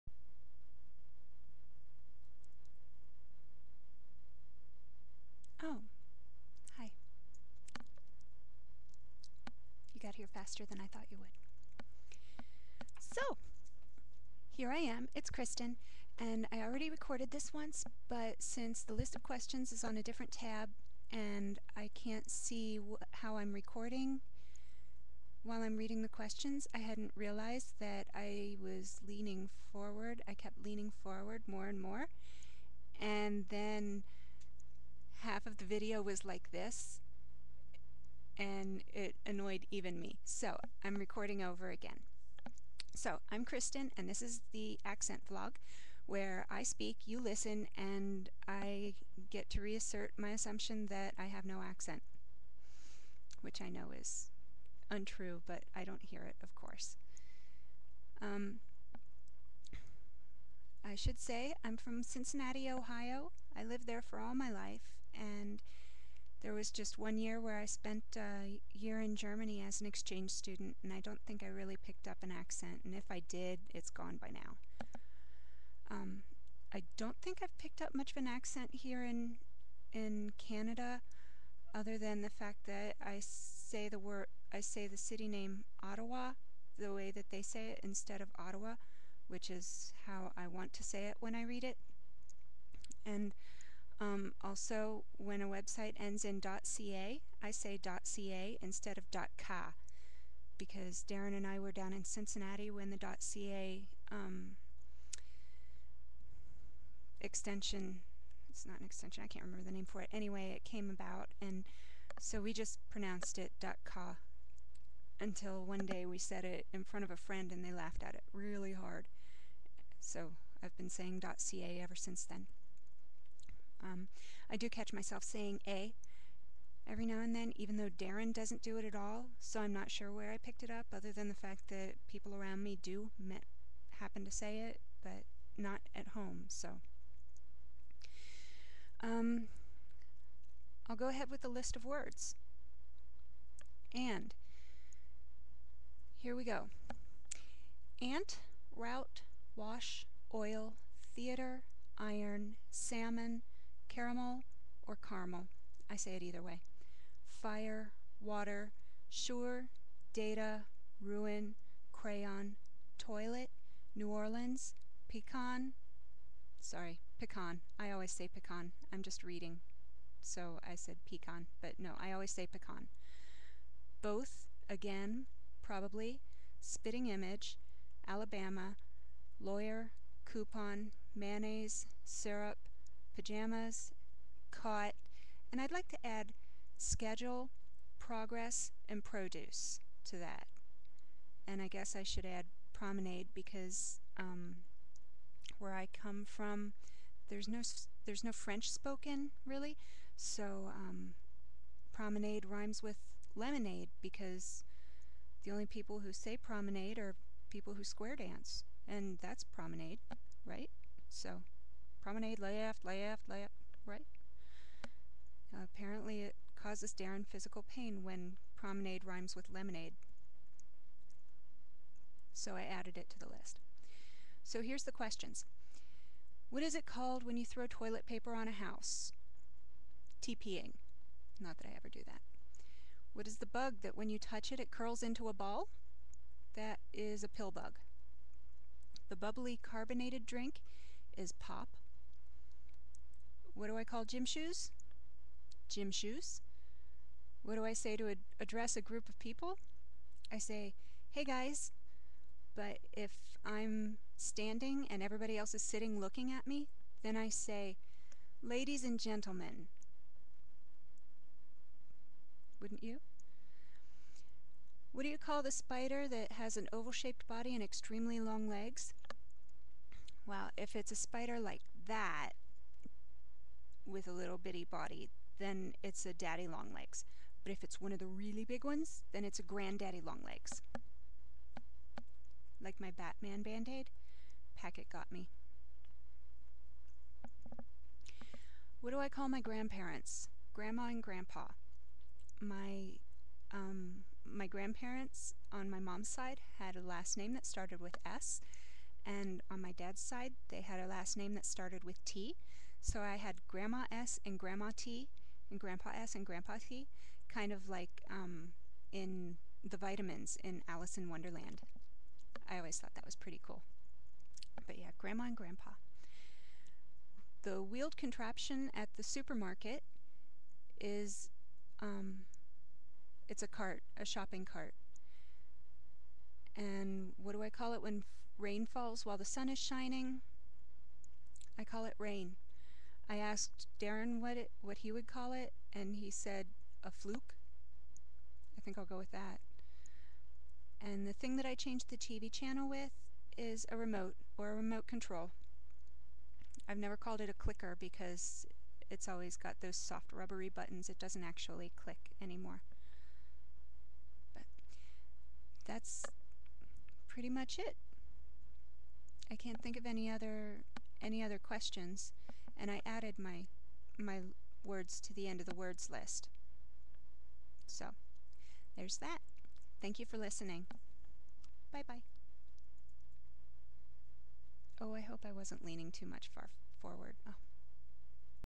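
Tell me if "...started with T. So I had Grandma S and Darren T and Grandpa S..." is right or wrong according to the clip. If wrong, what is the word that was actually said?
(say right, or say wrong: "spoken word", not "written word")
wrong: "Grandma", not "Darren".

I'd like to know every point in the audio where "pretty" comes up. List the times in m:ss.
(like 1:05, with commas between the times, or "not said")
5:13, 5:57.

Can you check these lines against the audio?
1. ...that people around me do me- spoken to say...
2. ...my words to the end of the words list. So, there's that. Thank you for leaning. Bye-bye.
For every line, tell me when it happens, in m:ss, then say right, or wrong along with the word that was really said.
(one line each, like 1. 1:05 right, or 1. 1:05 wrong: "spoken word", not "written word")
1. 2:11 wrong: "happen", not "spoken"
2. 6:03 wrong: "listening", not "leaning".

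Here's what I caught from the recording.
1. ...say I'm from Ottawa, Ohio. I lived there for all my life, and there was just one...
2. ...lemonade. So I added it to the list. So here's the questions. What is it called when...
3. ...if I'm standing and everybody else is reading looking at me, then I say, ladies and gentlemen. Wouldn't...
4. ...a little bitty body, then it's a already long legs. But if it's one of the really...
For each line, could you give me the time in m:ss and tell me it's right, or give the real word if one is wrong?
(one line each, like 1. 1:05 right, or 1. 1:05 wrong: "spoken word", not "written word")
1. 1:01 wrong: "Cincinnati", not "Ottawa"
2. 3:39 right
3. 4:12 wrong: "sitting", not "reading"
4. 4:34 wrong: "daddy", not "already".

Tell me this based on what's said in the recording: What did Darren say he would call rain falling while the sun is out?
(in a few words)
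a fluke.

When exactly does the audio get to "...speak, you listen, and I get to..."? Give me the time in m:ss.
0:46.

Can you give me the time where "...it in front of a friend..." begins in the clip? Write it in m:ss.
1:56.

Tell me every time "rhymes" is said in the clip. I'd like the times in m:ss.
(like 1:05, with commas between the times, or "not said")
3:22, 3:39.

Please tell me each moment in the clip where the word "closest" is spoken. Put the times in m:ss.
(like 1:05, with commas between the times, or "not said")
not said.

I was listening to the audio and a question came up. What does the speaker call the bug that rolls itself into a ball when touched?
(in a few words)
pill bug.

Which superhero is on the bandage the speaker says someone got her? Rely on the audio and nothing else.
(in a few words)
Batman.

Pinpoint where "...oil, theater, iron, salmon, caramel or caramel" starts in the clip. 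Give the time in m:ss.
2:30.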